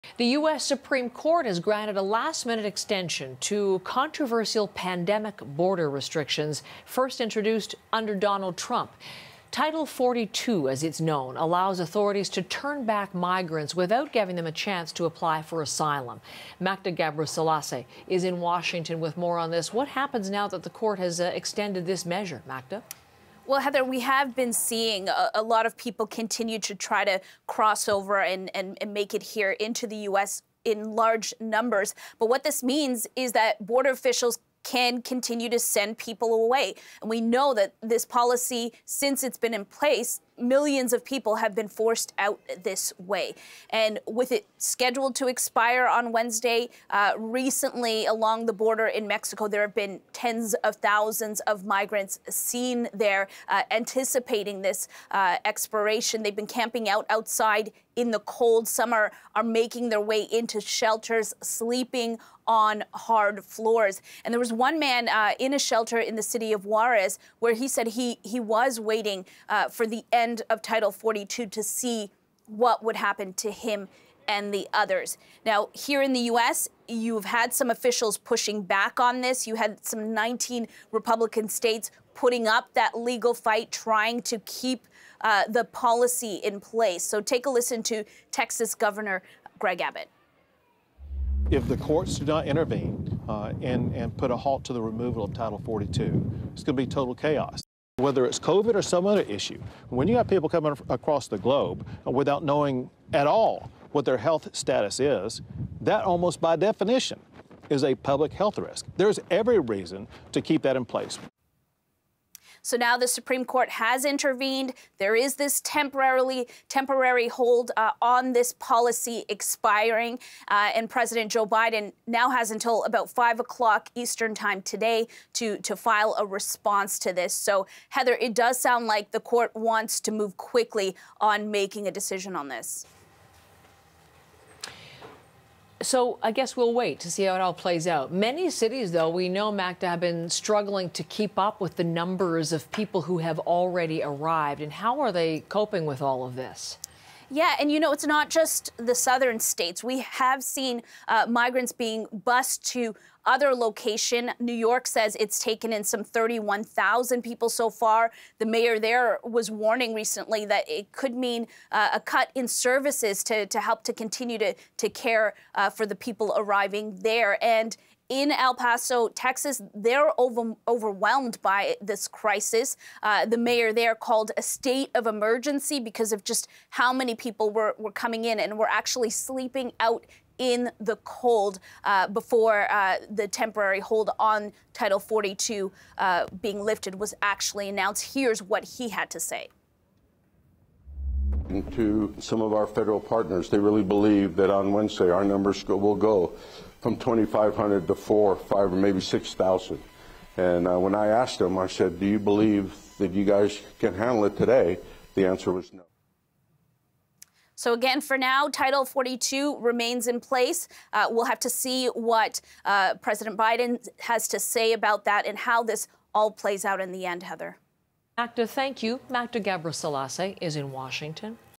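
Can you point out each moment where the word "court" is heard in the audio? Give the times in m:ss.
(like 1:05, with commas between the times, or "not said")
0:01, 0:20, 1:31, 1:53, 2:09.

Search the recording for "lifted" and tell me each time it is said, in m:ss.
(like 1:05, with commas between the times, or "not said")
3:06.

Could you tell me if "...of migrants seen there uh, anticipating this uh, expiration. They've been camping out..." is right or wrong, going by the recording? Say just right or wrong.
right.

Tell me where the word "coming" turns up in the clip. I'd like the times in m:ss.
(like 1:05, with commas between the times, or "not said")
1:40, 2:57.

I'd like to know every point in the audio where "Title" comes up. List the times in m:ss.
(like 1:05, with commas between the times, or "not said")
0:09, 1:10, 1:35, 3:04, 3:28.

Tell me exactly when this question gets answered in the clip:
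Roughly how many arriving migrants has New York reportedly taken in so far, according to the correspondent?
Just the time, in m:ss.
2:36.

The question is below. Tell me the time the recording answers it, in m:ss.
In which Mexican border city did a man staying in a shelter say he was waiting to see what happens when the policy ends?
1:06.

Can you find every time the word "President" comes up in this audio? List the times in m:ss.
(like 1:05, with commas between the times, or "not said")
2:00, 3:32.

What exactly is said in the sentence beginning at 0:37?
And we know that this policy, since it's been in place, millions of people have been forced out this way.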